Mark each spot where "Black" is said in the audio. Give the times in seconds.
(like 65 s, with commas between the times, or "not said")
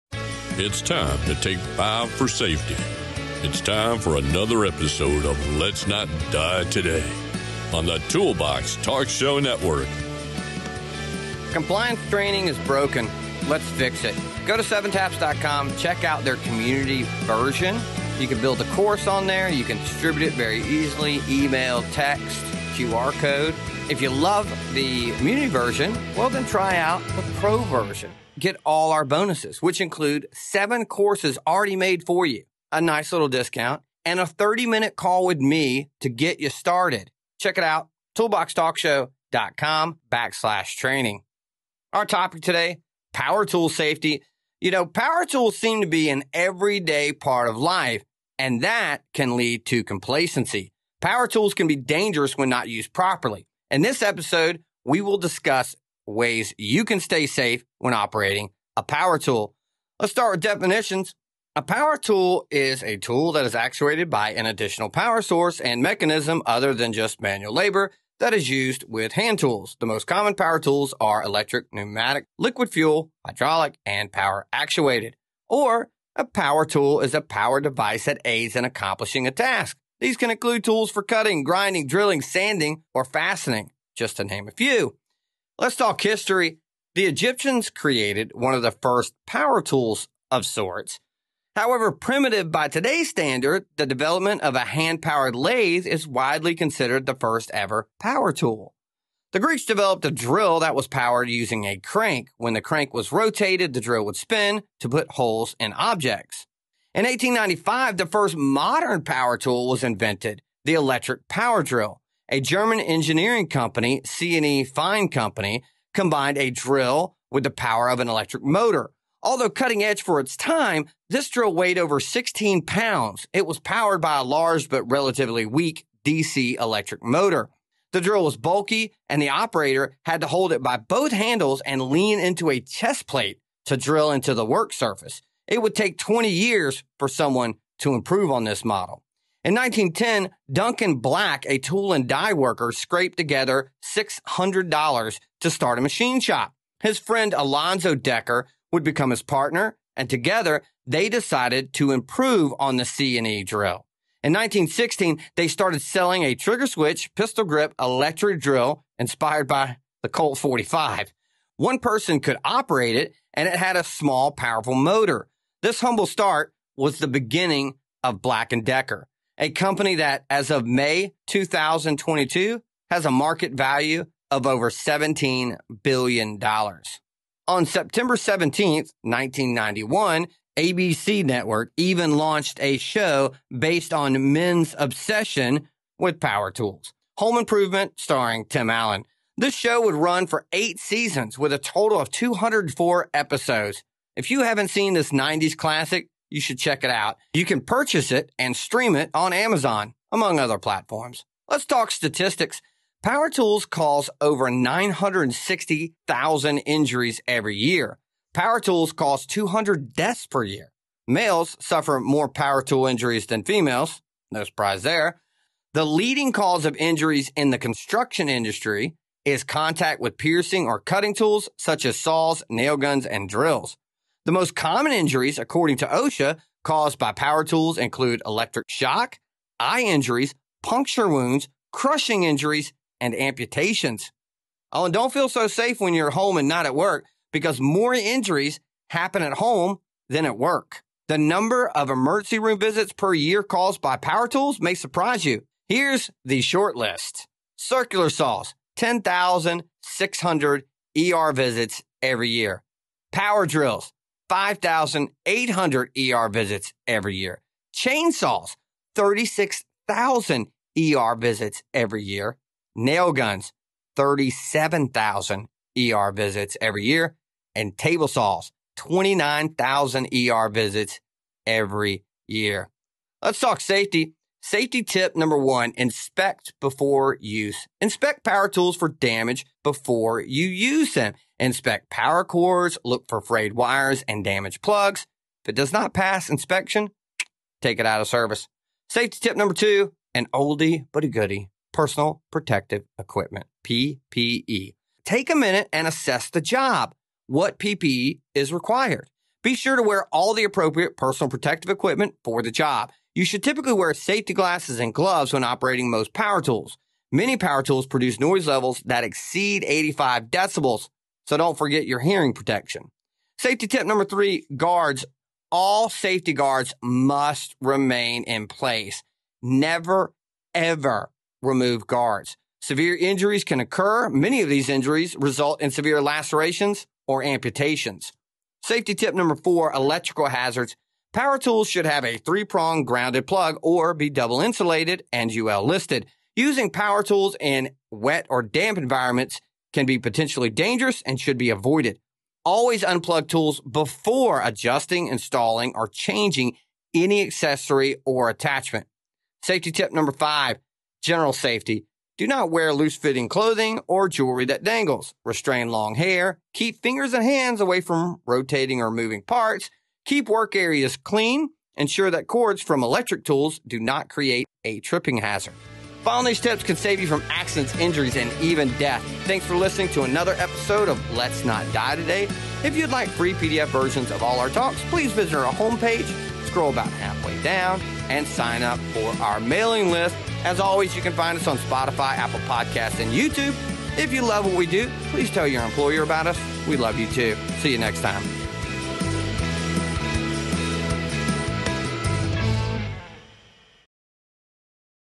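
140 s, 168 s.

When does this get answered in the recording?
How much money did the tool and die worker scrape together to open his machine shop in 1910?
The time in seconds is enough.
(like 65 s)
143 s.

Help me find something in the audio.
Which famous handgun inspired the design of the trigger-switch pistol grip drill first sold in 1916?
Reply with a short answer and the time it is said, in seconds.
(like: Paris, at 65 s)
Colt 45, at 160 s.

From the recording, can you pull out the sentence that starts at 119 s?
Although cutting edge for its time, this drill weighed over 16 pounds.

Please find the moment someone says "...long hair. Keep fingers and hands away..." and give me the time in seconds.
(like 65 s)
355 s.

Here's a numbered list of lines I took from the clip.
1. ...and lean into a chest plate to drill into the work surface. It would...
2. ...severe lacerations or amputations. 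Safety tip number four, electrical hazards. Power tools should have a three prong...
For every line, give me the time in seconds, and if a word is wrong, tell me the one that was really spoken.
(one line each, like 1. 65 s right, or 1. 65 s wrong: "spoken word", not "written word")
1. 131 s right
2. 325 s right.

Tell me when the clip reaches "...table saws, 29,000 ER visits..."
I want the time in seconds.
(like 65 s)
267 s.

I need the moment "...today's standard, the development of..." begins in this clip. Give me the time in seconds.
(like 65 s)
92 s.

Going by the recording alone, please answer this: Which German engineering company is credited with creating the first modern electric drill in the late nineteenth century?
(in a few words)
C&E Fein Company.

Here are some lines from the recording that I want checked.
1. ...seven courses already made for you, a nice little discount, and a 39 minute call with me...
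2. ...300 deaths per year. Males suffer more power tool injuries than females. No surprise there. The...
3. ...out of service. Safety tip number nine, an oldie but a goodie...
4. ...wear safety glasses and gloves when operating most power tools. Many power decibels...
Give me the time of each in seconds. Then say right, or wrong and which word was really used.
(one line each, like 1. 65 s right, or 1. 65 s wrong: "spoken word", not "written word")
1. 30 s wrong: "30", not "39"
2. 209 s wrong: "200", not "300"
3. 287 s wrong: "two", not "nine"
4. 303 s wrong: "tools", not "decibels".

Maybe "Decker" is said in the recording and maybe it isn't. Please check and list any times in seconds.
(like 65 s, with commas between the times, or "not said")
147 s, 168 s.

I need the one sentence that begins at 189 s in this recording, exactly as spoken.
This show would run for eight seasons with a total of 204 episodes.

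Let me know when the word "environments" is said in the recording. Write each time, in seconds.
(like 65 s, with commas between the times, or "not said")
338 s.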